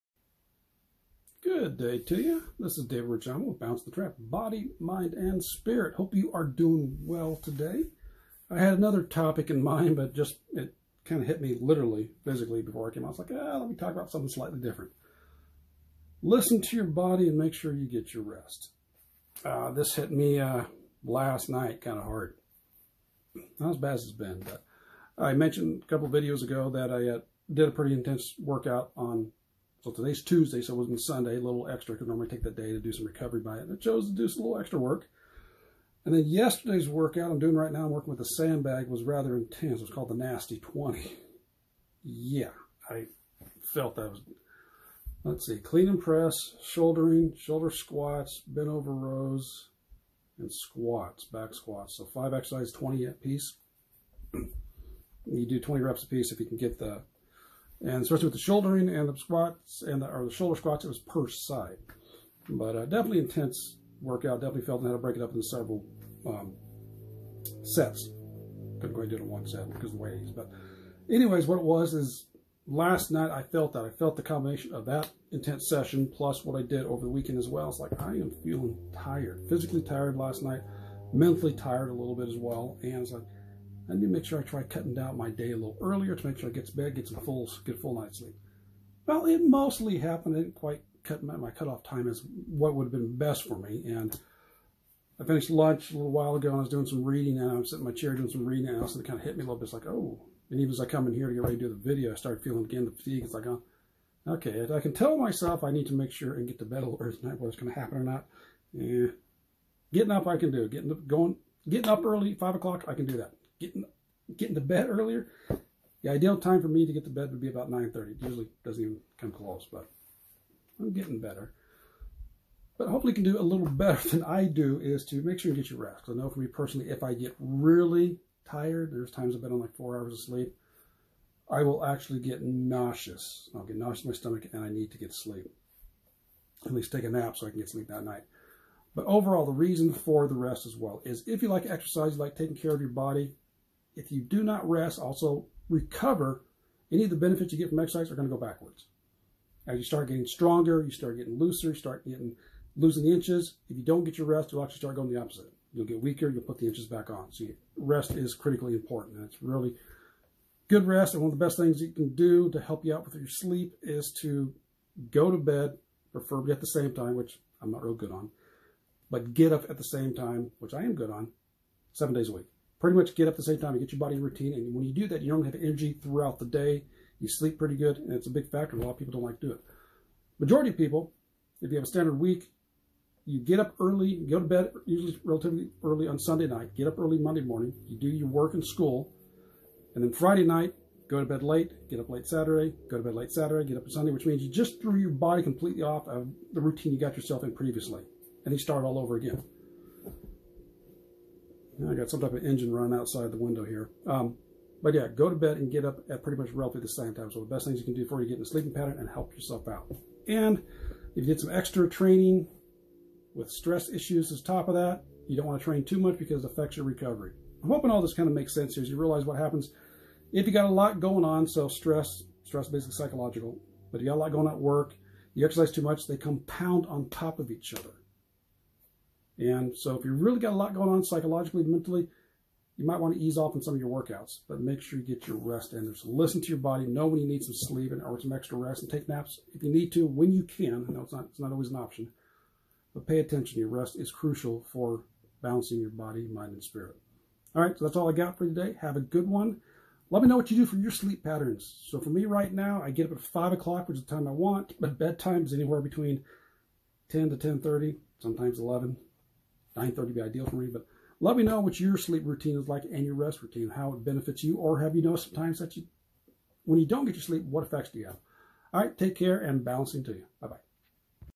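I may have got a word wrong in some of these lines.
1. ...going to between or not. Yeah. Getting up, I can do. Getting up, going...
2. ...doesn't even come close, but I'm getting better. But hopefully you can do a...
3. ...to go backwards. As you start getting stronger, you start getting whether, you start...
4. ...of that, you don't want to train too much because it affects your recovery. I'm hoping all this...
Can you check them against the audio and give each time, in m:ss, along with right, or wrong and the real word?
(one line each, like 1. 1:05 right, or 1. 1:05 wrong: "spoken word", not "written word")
1. 1:47 wrong: "happen", not "between"
2. 1:58 right
3. 2:28 wrong: "looser", not "whether"
4. 3:34 right.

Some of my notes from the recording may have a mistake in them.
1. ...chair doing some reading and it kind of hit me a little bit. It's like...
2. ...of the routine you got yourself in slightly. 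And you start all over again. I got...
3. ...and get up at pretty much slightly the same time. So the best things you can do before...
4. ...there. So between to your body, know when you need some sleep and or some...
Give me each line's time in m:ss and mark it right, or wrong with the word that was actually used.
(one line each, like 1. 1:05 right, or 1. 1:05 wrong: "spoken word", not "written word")
1. 1:37 right
2. 3:16 wrong: "previously", not "slightly"
3. 3:25 wrong: "roughly", not "slightly"
4. 3:55 wrong: "listen", not "between".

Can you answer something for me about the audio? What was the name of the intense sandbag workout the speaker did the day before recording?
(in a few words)
Nasty 20.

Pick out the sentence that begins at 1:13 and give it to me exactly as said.
I felt the combination of that intense session plus what I did over the weekend as well.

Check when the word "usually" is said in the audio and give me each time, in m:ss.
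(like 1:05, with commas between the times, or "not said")
1:58, 3:04.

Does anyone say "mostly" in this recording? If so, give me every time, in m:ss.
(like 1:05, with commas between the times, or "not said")
1:29.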